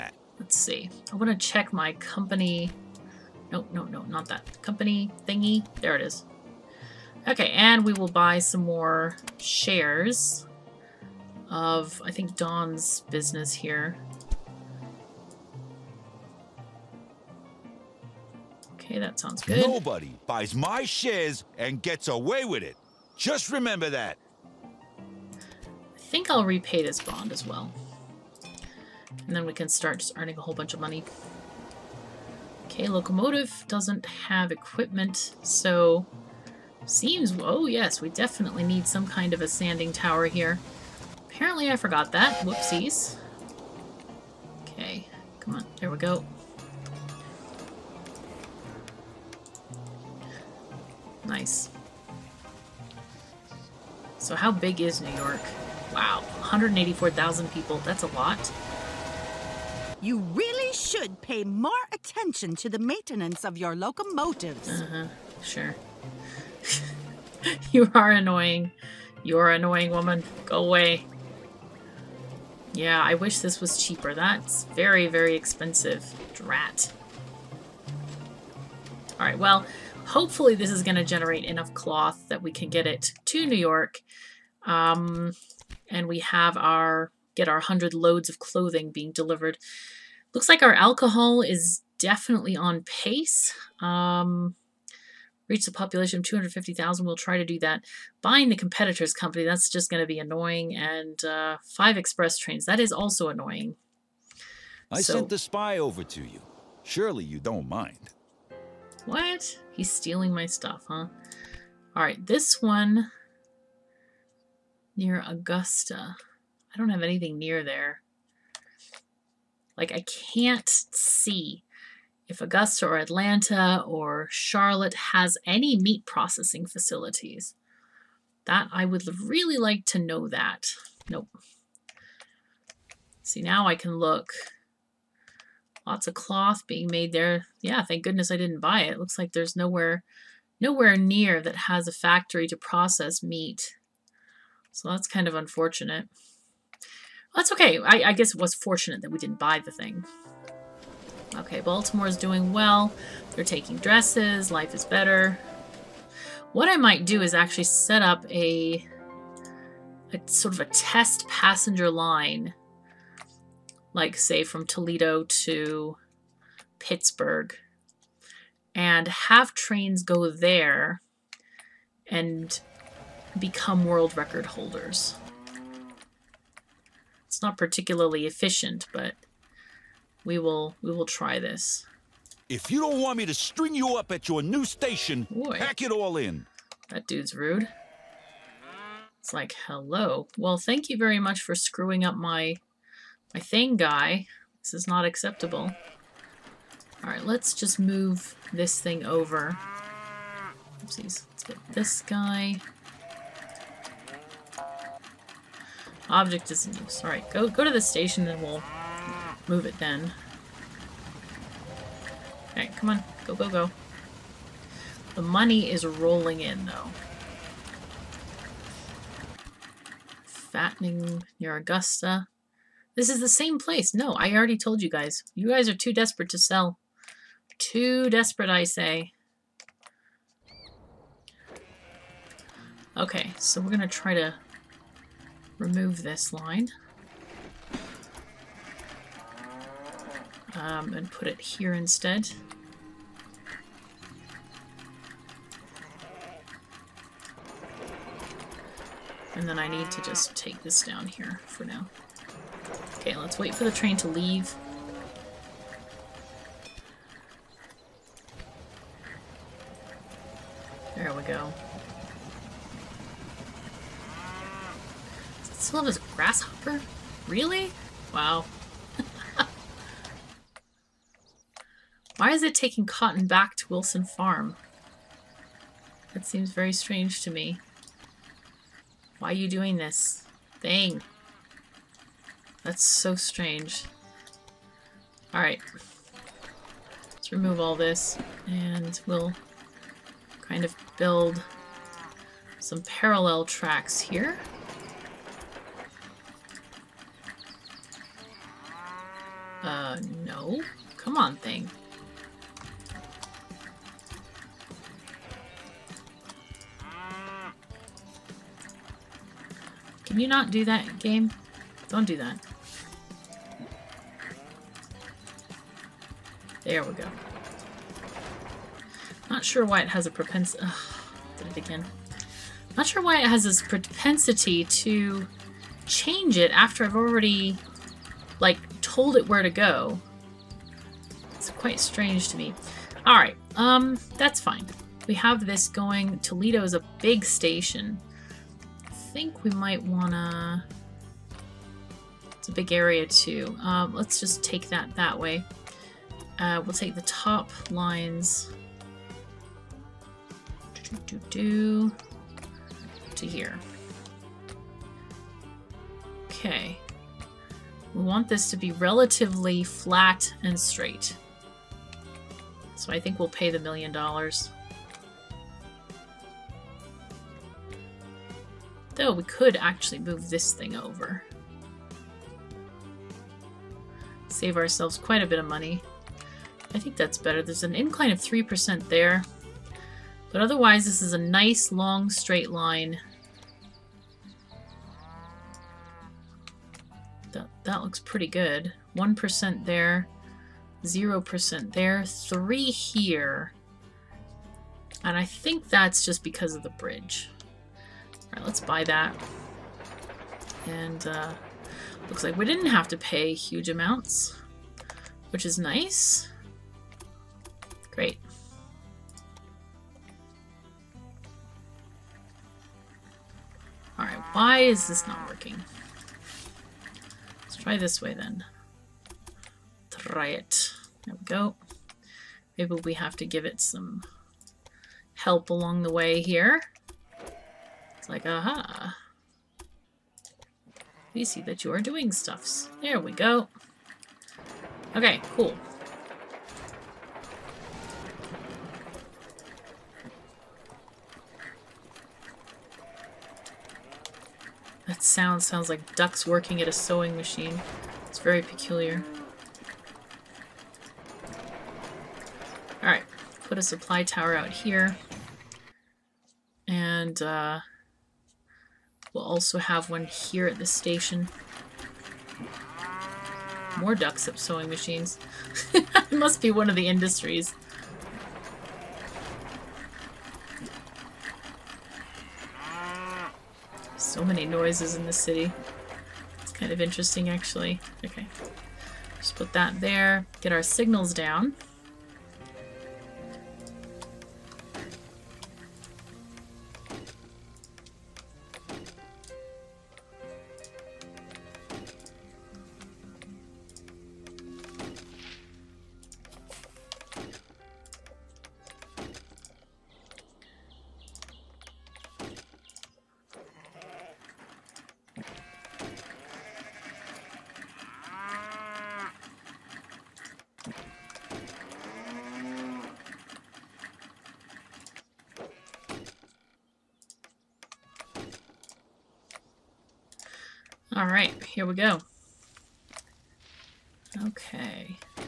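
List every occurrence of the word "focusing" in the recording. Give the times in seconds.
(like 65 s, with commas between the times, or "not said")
not said.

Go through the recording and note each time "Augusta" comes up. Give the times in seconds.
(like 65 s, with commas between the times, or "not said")
115 s, 122 s, 221 s.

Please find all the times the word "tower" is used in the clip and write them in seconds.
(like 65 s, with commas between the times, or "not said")
39 s, 454 s.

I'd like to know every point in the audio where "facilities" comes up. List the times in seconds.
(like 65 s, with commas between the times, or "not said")
126 s.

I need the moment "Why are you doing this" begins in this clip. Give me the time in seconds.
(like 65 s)
279 s.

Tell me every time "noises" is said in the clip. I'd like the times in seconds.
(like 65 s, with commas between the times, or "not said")
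474 s.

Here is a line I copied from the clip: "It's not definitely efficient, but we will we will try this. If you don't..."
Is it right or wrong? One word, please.
wrong.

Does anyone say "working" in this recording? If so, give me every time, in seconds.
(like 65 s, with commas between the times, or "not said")
415 s, 446 s.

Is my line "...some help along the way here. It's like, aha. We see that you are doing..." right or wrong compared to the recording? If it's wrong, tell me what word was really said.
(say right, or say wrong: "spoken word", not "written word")
right.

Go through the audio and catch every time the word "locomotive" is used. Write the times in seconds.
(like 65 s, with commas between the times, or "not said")
32 s, 63 s.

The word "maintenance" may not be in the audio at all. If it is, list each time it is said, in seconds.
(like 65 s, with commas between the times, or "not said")
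62 s.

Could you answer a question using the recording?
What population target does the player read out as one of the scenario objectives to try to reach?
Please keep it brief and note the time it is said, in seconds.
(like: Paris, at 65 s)
250,000, at 96 s.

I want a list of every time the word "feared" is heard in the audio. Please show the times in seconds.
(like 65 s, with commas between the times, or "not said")
not said.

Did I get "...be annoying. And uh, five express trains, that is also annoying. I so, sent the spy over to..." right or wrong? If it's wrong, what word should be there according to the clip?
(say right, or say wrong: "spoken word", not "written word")
right.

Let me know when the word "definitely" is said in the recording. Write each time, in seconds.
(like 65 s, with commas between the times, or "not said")
38 s, 91 s.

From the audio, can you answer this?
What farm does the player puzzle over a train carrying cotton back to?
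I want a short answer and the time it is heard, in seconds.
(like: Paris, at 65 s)
Wilson Farm, at 273 s.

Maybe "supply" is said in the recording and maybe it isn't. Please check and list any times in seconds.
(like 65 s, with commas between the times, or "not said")
453 s.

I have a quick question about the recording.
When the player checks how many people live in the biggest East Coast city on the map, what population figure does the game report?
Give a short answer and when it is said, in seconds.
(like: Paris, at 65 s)
184,000, at 56 s.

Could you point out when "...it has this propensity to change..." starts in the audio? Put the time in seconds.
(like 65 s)
323 s.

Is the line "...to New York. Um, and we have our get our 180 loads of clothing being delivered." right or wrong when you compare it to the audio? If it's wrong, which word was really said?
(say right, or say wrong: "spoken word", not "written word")
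wrong: "100", not "180".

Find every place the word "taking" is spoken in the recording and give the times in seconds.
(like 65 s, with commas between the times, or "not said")
153 s, 272 s.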